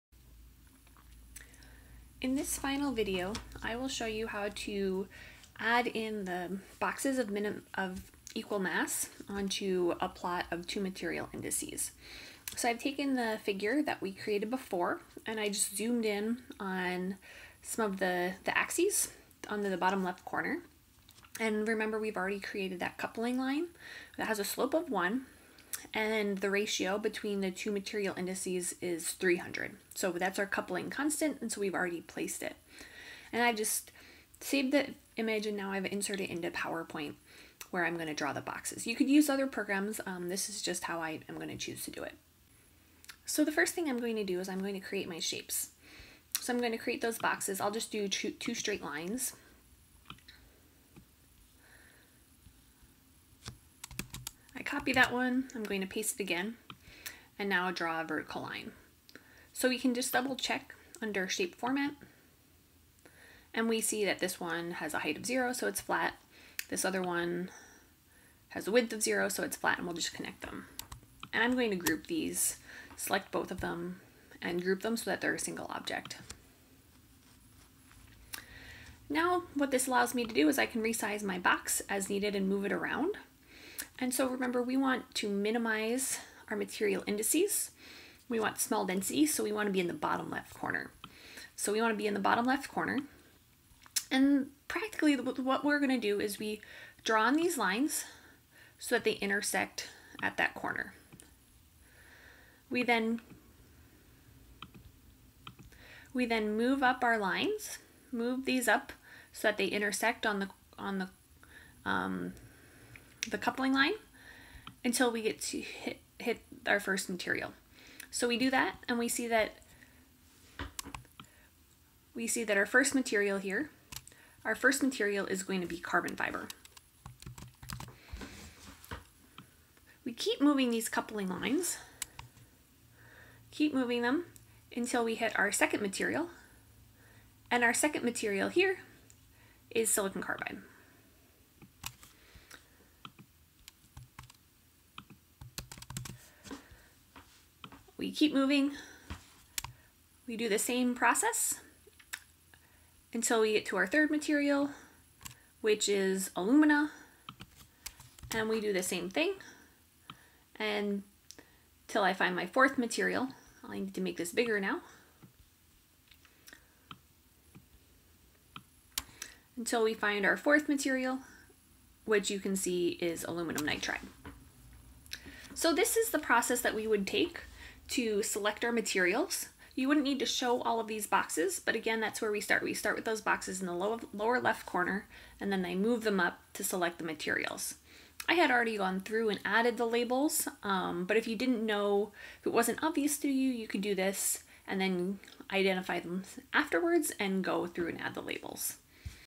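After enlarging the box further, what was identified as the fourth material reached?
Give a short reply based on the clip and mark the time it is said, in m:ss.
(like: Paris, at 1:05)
Aluminum nitride, at 2:53.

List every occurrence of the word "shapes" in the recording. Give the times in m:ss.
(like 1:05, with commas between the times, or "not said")
0:45, 1:01.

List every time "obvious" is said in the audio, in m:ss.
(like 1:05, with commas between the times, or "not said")
3:12.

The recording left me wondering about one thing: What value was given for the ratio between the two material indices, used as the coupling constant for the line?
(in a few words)
300.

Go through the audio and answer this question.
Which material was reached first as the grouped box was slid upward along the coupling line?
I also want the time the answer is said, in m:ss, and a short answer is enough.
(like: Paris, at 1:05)
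Carbon fiber, at 2:05.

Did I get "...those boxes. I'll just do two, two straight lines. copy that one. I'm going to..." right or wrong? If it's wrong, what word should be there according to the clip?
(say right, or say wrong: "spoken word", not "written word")
right.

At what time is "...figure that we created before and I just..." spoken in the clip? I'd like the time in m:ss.
0:13.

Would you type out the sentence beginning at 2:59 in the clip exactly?
You wouldn't need to show all of these boxes, but again, that's where we start.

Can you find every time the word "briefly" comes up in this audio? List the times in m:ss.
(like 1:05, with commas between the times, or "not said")
not said.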